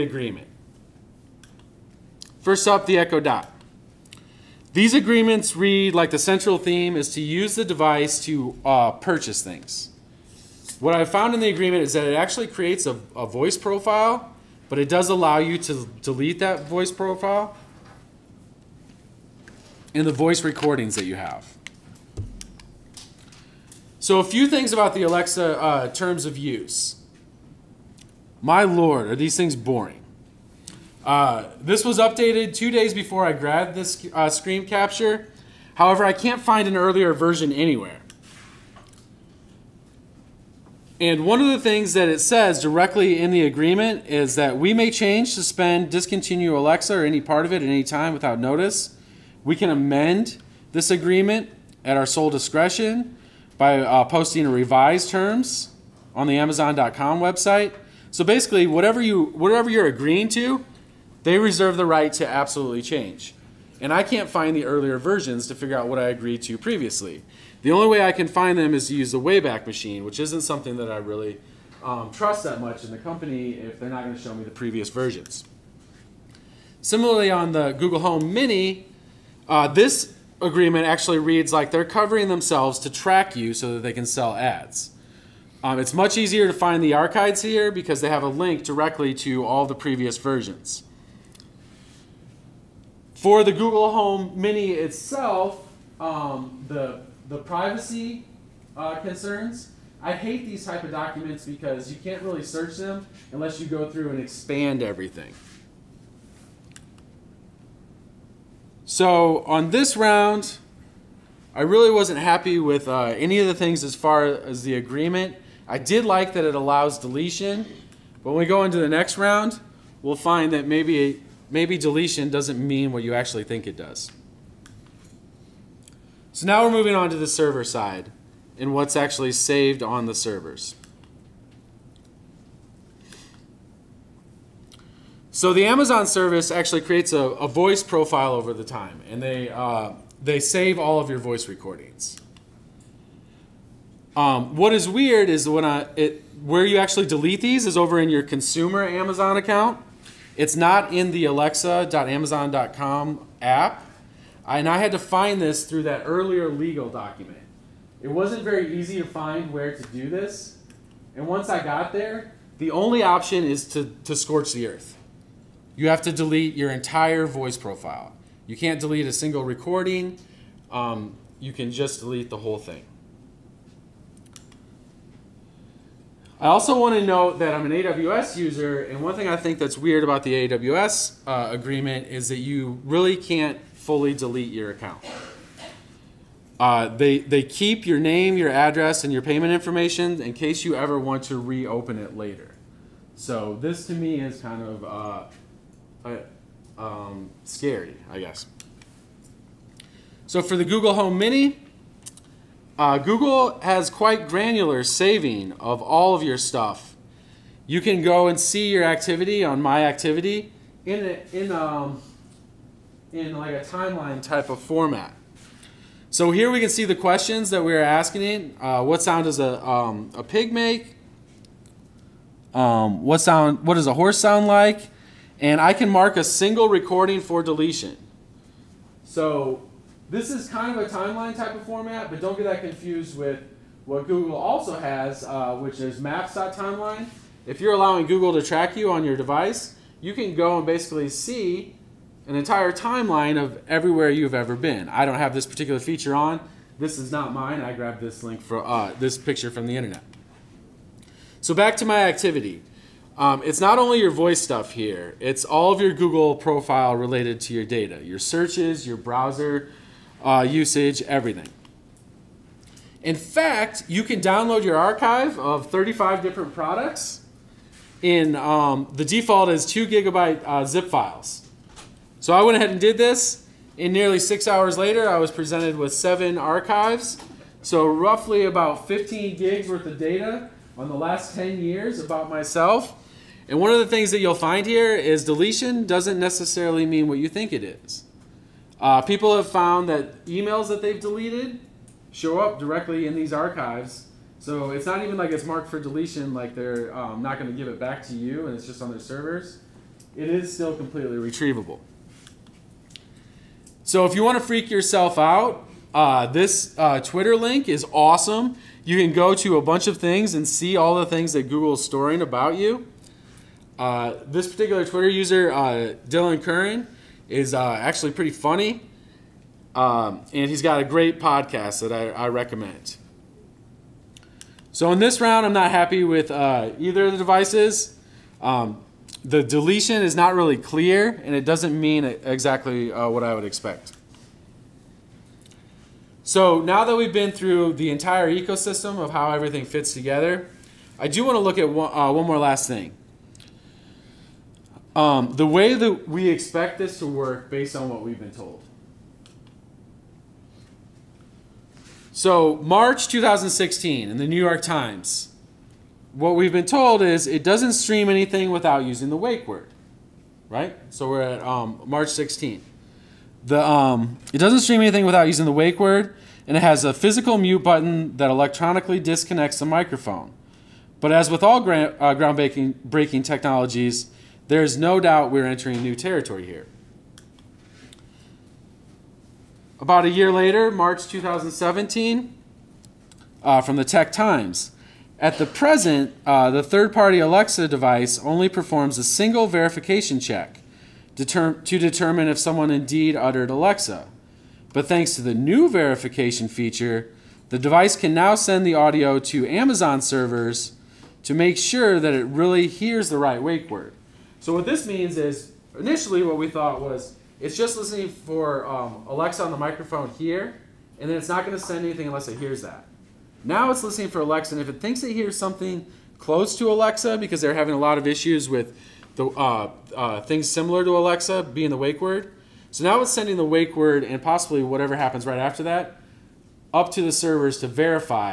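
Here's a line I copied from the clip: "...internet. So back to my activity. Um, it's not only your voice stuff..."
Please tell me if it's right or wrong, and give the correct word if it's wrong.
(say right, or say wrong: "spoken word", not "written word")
right.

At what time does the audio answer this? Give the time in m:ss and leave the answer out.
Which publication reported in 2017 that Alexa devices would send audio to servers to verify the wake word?
6:23.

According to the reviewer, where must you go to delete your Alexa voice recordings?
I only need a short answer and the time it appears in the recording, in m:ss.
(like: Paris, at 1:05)
Consumer Amazon account, at 2:28.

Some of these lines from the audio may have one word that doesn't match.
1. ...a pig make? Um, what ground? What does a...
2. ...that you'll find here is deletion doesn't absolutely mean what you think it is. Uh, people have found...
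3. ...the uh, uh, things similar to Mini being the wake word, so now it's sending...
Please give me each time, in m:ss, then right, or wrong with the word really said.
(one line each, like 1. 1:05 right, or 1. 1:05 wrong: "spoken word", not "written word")
1. 3:40 wrong: "sound", not "ground"
2. 4:44 wrong: "necessarily", not "absolutely"
3. 6:59 wrong: "Alexa", not "Mini".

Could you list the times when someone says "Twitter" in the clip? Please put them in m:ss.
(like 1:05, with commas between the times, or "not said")
5:06, 5:14.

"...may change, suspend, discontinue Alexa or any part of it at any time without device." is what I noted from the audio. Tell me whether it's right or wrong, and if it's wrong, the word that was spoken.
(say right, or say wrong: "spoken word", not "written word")
wrong: "notice", not "device".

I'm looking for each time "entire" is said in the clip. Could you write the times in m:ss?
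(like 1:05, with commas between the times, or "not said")
2:46, 4:02, 5:37.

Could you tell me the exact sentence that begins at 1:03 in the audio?
And I can't find the earlier versions to figure out what I agreed to previously.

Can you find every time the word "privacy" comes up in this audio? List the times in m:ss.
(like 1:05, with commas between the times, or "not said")
1:37.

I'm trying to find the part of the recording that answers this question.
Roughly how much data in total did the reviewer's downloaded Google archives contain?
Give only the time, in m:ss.
4:38.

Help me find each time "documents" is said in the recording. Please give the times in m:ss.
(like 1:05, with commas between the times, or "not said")
1:40, 2:36.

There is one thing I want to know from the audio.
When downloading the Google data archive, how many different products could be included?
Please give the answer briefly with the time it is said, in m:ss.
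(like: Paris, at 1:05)
35, at 4:25.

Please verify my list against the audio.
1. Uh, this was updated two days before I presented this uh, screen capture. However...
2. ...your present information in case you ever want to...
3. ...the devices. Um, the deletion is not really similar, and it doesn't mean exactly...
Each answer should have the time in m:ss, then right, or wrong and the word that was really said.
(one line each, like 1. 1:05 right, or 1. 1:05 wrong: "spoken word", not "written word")
1. 0:31 wrong: "grabbed", not "presented"
2. 3:09 wrong: "payment", not "present"
3. 5:27 wrong: "clear", not "similar".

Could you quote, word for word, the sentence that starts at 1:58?
But when we go into the next round, we'll find that maybe maybe deletion doesn't mean what you actually think it does.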